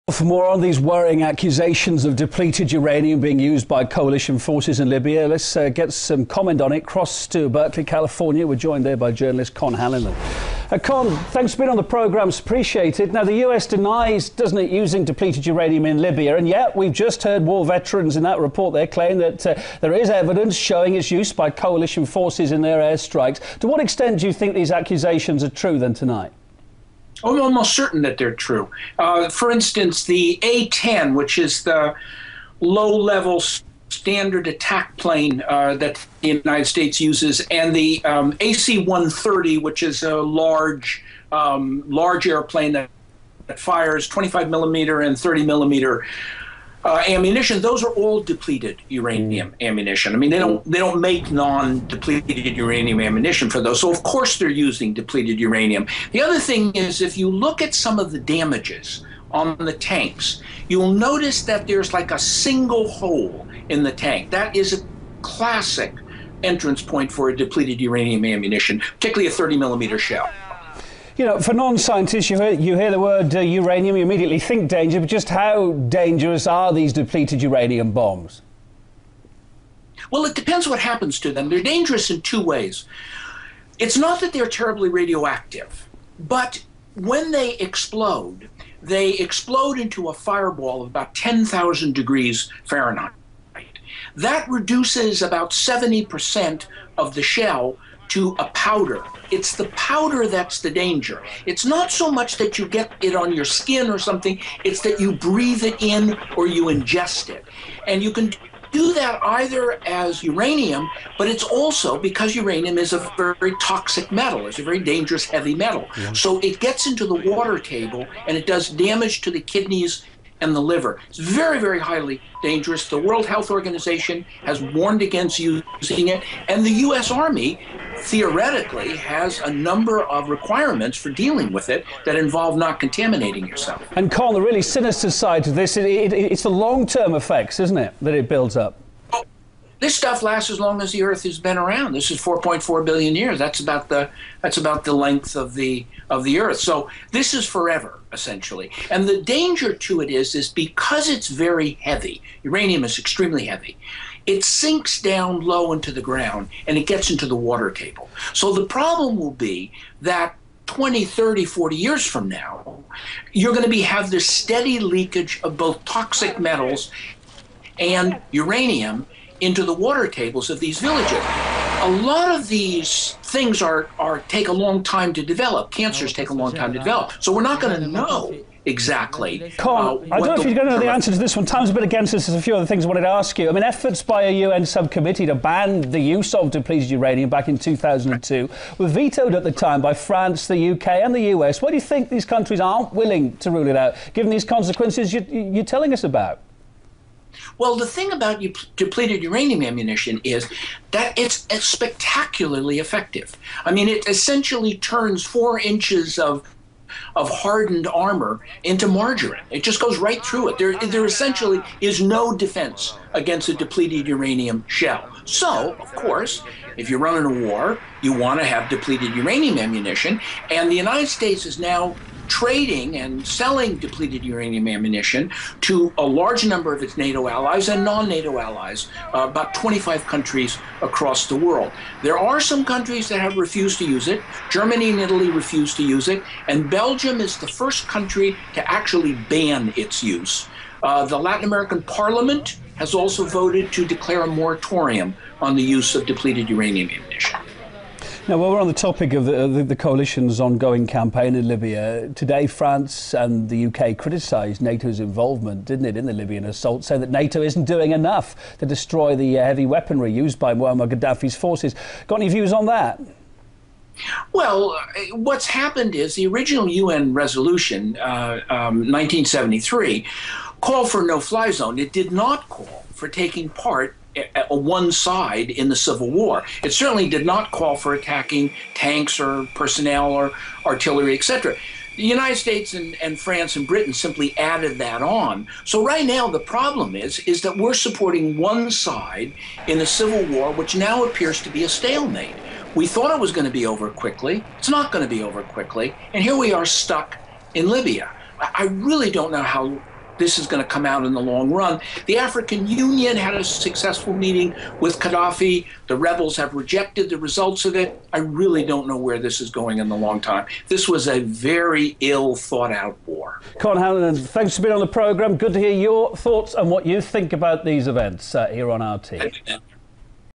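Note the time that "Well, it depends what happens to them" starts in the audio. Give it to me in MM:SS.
01:20.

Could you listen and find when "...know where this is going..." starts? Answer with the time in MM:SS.
05:08.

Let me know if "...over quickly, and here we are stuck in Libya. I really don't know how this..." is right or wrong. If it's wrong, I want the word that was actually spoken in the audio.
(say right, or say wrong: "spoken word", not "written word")
right.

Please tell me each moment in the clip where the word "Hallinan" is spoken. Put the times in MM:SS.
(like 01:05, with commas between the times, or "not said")
00:09, 05:13.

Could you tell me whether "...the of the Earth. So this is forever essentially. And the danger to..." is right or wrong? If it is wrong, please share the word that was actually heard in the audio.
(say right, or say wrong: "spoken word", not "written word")
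right.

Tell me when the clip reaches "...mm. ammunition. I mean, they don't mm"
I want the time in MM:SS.
00:49.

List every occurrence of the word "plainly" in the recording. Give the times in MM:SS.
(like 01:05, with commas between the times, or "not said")
not said.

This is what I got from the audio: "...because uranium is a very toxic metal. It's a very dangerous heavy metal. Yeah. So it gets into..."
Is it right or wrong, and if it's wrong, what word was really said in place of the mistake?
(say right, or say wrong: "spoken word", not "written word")
right.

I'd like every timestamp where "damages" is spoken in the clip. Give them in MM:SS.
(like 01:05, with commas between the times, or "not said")
00:58, 01:58.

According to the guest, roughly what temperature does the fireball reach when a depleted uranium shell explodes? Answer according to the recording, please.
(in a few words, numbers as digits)
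10,000 degrees Fahrenheit.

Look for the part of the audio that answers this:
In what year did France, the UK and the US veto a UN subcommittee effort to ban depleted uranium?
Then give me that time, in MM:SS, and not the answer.
03:07.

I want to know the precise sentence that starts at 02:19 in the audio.
This stuff lasts as long as the Earth has been around.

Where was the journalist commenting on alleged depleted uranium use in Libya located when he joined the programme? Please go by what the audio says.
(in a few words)
Berkeley, California.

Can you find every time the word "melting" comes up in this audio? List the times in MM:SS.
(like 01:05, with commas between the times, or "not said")
not said.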